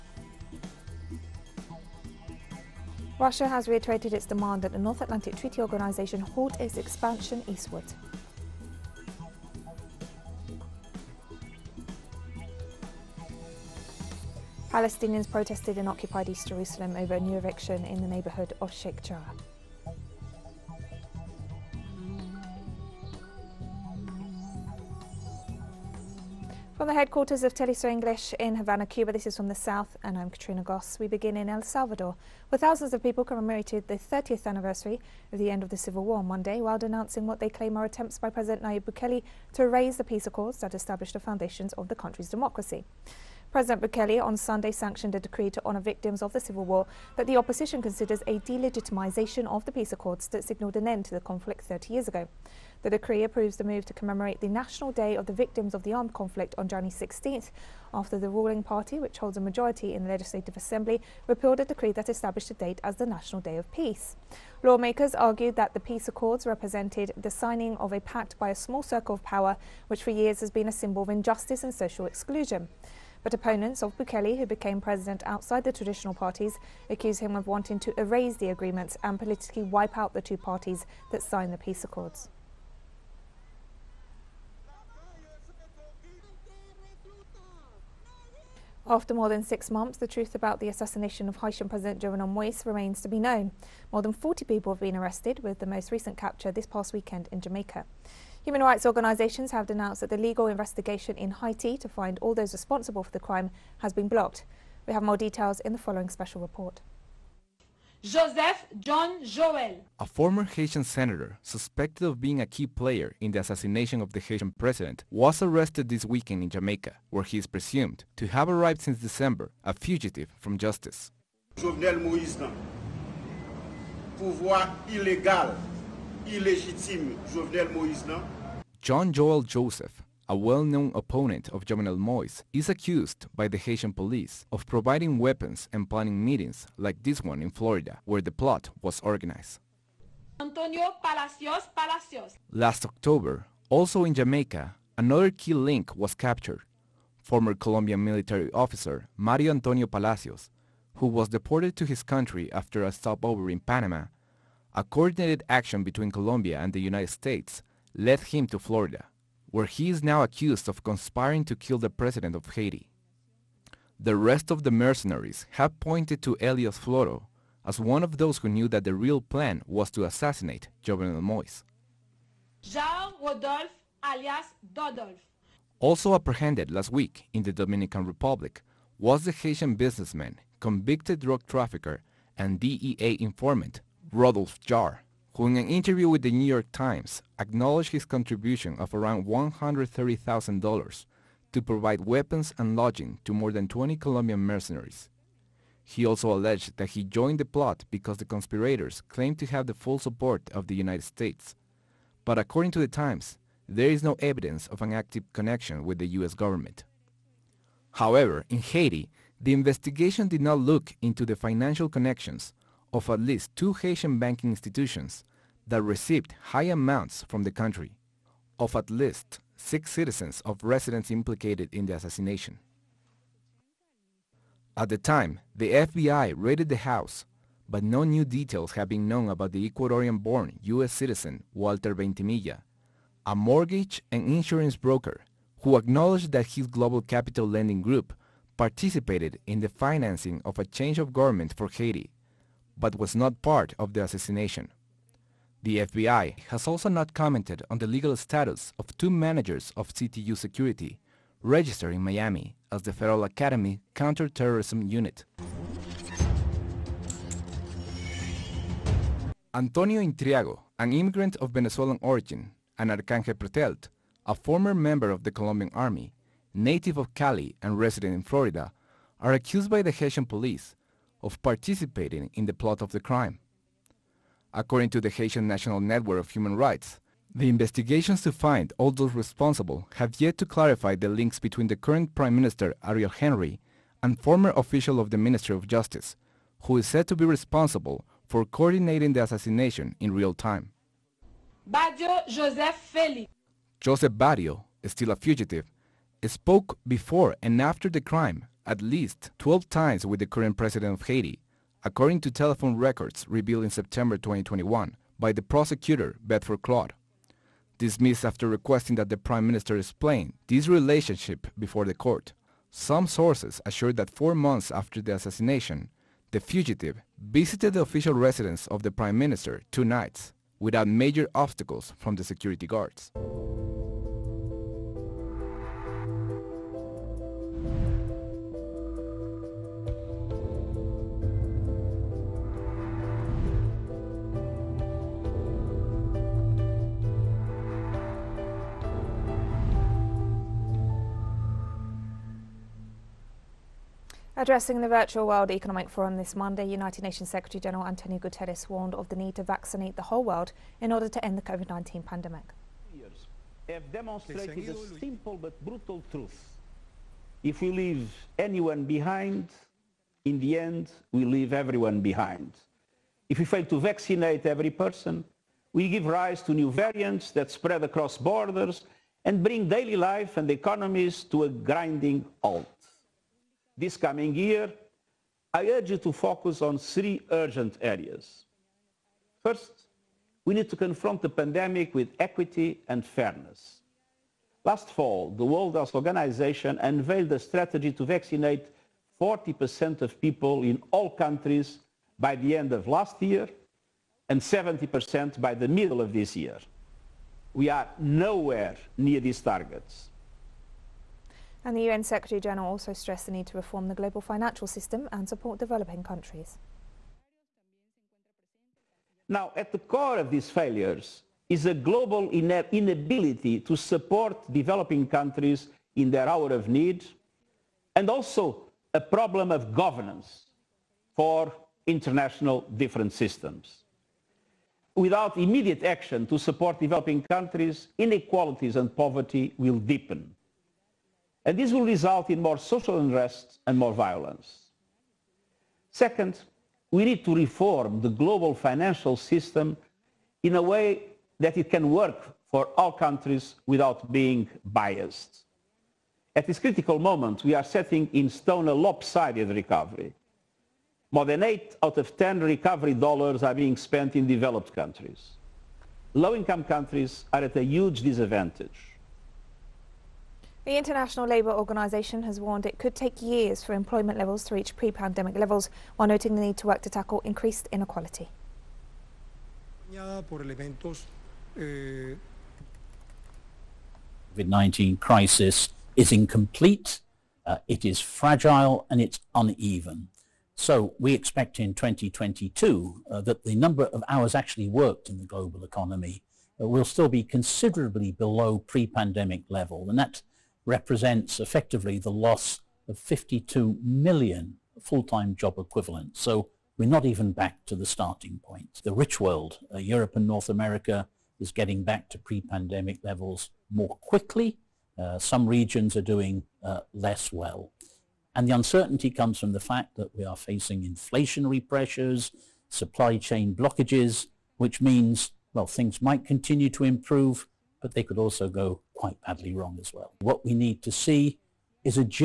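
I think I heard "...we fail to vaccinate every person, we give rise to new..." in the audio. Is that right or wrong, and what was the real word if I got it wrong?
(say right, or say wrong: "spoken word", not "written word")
right.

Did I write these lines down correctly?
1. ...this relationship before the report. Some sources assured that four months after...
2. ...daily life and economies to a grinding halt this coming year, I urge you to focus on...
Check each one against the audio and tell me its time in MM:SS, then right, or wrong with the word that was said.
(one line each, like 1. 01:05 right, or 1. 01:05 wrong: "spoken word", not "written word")
1. 05:10 wrong: "court", not "report"
2. 06:09 right.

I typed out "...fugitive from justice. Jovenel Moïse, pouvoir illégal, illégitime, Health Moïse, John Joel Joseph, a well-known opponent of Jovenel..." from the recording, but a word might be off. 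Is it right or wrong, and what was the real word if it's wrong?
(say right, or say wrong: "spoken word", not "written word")
wrong: "Jovenel", not "Health".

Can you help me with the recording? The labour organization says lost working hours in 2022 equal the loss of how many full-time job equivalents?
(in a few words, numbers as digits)
52 million.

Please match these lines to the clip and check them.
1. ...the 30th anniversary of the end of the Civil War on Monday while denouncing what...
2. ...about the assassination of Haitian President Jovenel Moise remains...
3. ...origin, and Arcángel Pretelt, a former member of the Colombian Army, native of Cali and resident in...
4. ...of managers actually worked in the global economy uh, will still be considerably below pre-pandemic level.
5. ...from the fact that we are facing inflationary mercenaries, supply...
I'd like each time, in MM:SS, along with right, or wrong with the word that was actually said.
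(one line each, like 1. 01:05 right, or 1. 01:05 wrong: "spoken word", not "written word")
1. 00:33 right
2. 01:30 right
3. 04:22 right
4. 08:03 wrong: "hours", not "managers"
5. 08:29 wrong: "pressures", not "mercenaries".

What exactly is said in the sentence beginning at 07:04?
Without immediate action to support developing countries, inequalities and poverty will deepen.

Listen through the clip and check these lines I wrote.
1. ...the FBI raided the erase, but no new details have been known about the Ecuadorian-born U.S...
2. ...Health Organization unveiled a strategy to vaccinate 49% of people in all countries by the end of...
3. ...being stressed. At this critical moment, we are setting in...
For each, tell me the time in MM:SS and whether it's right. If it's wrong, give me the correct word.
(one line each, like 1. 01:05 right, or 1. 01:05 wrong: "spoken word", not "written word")
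1. 03:45 wrong: "house", not "erase"
2. 06:25 wrong: "40", not "49"
3. 07:24 wrong: "biased", not "stressed".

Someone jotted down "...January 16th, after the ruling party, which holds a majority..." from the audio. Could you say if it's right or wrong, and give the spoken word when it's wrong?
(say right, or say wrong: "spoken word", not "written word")
right.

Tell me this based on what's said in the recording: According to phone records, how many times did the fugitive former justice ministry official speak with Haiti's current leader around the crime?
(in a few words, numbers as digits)
12.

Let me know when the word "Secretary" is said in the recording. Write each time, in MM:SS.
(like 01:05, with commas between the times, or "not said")
05:47, 06:42.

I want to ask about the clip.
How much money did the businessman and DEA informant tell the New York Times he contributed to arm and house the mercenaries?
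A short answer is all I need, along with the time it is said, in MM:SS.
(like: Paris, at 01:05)
$130,000, at 03:09.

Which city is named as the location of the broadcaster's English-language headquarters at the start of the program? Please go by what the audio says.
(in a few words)
Havana.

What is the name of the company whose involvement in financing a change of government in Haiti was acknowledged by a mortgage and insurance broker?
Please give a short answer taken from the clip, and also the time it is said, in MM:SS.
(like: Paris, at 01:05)
Global Capital Lending Group, at 03:56.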